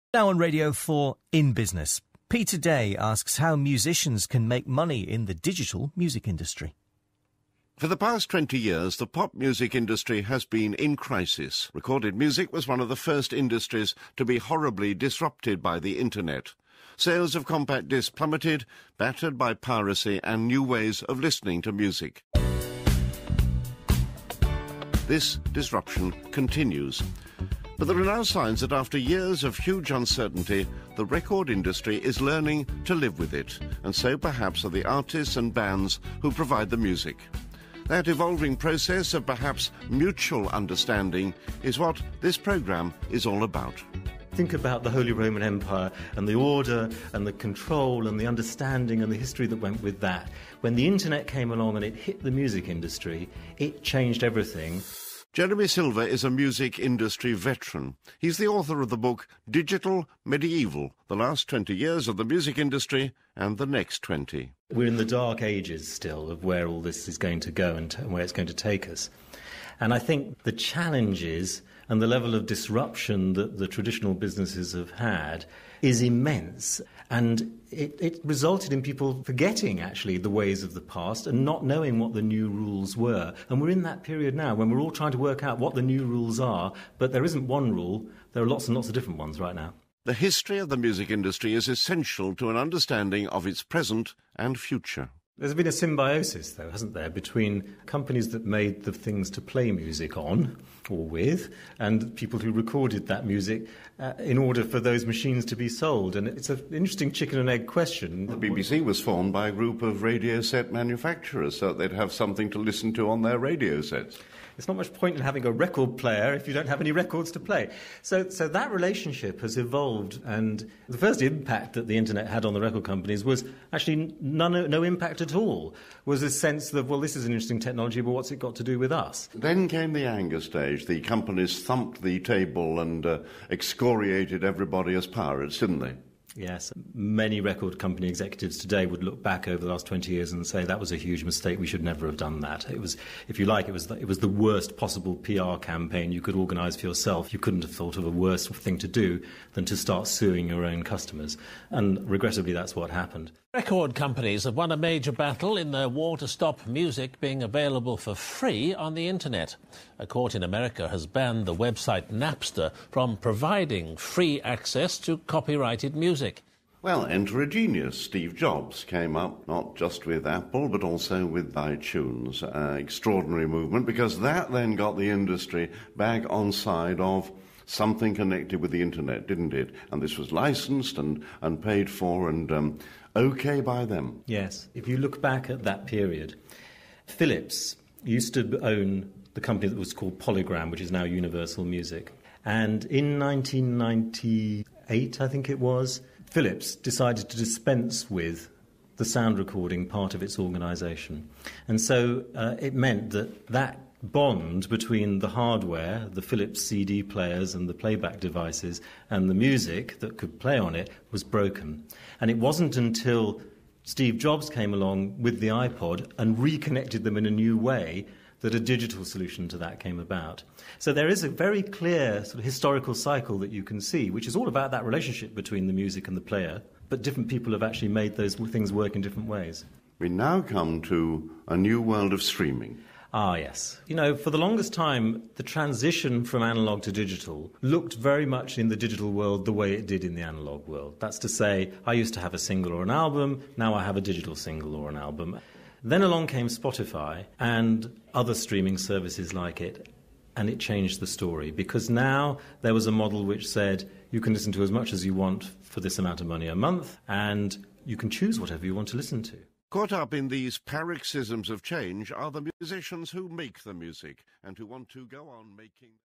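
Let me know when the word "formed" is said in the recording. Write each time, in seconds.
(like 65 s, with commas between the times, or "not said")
109 s.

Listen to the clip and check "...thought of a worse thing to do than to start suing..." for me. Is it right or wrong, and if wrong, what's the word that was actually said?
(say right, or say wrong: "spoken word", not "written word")
right.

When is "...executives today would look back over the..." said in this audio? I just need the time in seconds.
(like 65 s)
138 s.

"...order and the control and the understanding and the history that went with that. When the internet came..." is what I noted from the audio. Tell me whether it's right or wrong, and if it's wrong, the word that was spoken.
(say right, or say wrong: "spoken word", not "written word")
right.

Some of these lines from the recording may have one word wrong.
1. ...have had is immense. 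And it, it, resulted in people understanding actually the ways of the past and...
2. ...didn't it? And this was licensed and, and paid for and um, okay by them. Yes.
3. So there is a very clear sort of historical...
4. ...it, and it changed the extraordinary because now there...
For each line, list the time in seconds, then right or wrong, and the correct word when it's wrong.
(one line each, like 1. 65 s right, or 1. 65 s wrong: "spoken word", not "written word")
1. 74 s wrong: "forgetting", not "understanding"
2. 179 s right
3. 220 s right
4. 249 s wrong: "story", not "extraordinary".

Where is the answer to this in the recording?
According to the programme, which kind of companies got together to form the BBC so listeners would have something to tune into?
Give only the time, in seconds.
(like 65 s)
110 s.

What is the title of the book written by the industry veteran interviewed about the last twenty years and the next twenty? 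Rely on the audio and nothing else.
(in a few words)
Digital Medieval.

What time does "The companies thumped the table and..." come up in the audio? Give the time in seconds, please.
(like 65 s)
130 s.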